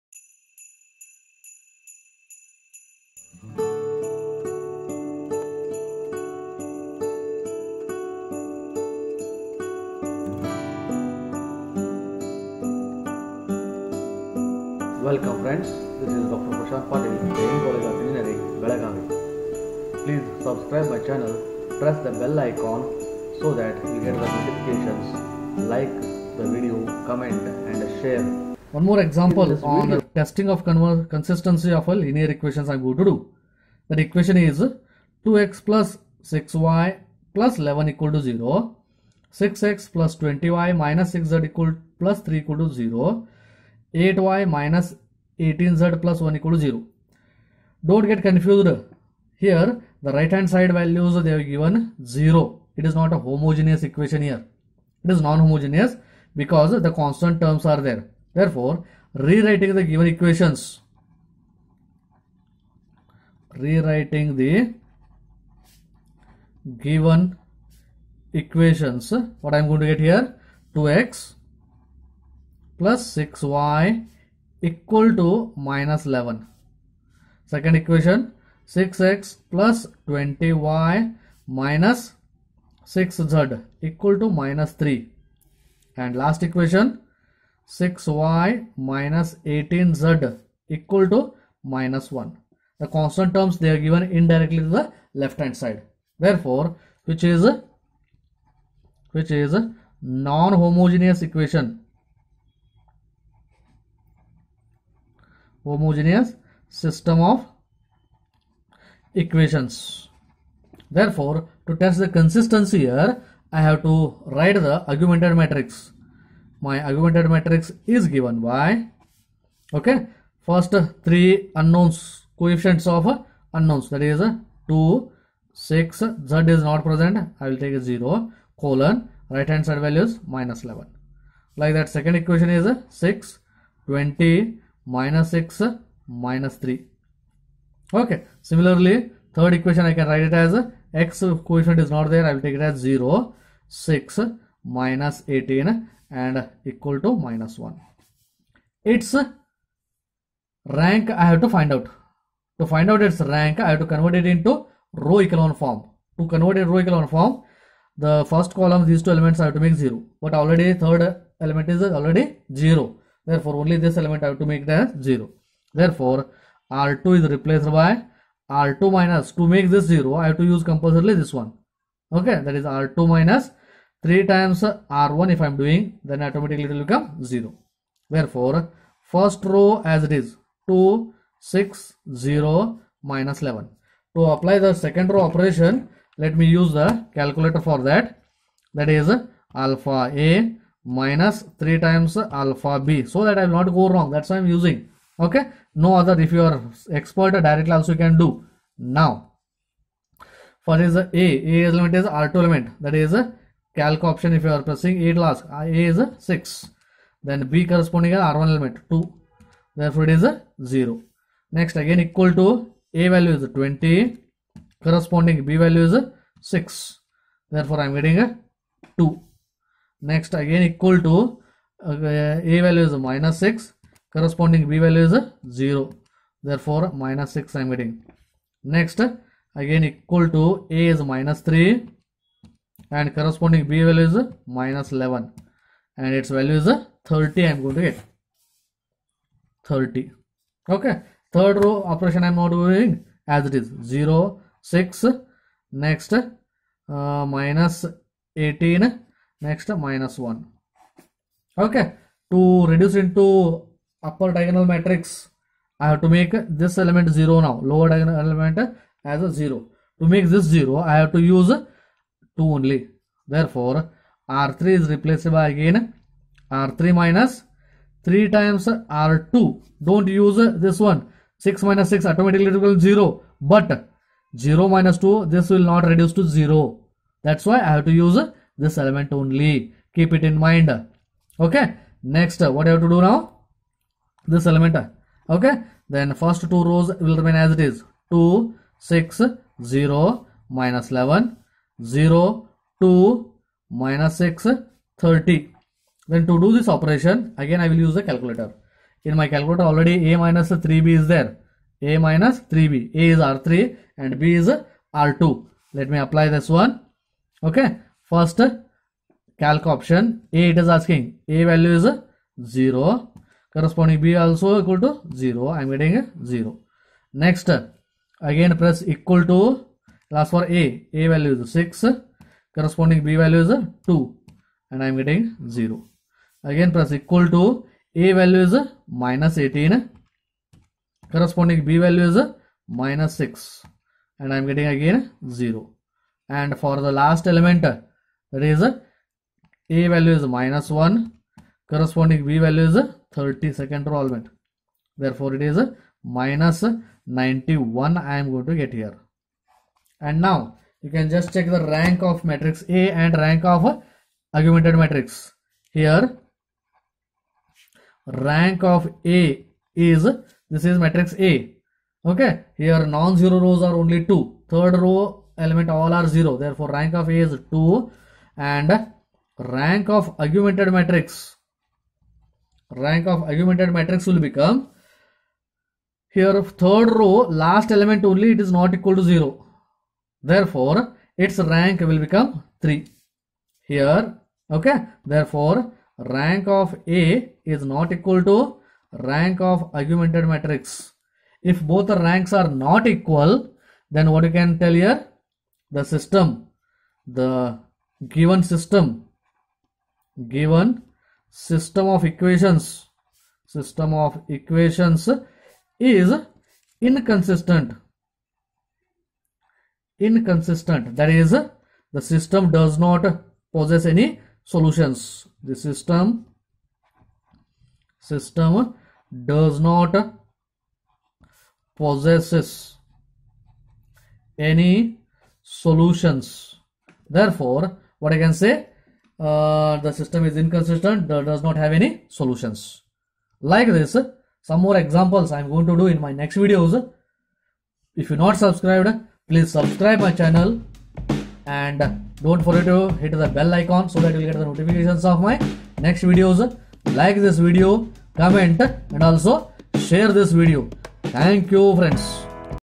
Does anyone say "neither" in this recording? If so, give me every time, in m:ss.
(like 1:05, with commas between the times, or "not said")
not said.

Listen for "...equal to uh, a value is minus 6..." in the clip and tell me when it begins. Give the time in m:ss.
3:40.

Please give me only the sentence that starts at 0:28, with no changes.
One more example on the testing of consistency of a linear equations I'm going to do.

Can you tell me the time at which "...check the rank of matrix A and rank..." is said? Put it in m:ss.
5:51.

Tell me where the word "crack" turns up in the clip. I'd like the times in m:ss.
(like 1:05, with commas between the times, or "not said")
not said.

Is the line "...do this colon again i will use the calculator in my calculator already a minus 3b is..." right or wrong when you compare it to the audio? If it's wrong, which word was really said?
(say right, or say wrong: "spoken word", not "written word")
wrong: "operation", not "colon".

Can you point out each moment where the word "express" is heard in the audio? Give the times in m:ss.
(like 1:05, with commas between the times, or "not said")
not said.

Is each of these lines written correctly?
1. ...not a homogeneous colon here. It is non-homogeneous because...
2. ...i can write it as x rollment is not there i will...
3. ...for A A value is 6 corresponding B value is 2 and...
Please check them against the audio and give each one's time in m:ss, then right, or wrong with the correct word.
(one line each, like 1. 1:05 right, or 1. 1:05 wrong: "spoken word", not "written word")
1. 0:52 wrong: "equation", not "colon"
2. 2:19 wrong: "coefficient", not "rollment"
3. 5:20 right.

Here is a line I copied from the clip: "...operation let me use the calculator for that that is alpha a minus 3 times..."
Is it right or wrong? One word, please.
right.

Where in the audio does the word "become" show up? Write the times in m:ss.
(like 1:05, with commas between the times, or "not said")
2:56, 6:14, 6:22.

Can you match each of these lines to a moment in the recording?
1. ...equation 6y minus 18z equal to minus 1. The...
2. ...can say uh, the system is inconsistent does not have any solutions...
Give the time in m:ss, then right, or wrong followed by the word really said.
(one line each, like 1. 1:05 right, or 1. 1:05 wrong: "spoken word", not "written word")
1. 1:26 right
2. 7:08 right.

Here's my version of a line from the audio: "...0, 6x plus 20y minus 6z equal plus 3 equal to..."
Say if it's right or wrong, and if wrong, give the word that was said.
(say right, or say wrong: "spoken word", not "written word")
right.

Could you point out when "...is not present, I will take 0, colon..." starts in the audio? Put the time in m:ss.
2:06.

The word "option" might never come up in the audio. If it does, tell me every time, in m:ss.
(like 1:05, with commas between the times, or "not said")
3:24, 5:09.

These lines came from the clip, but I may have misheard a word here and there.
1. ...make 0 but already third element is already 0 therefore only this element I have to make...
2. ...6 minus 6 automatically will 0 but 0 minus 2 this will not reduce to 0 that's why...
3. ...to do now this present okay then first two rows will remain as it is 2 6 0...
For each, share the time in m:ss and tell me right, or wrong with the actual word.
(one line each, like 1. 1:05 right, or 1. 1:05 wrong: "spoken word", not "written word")
1. 2:39 right
2. 4:31 right
3. 4:42 wrong: "element", not "present".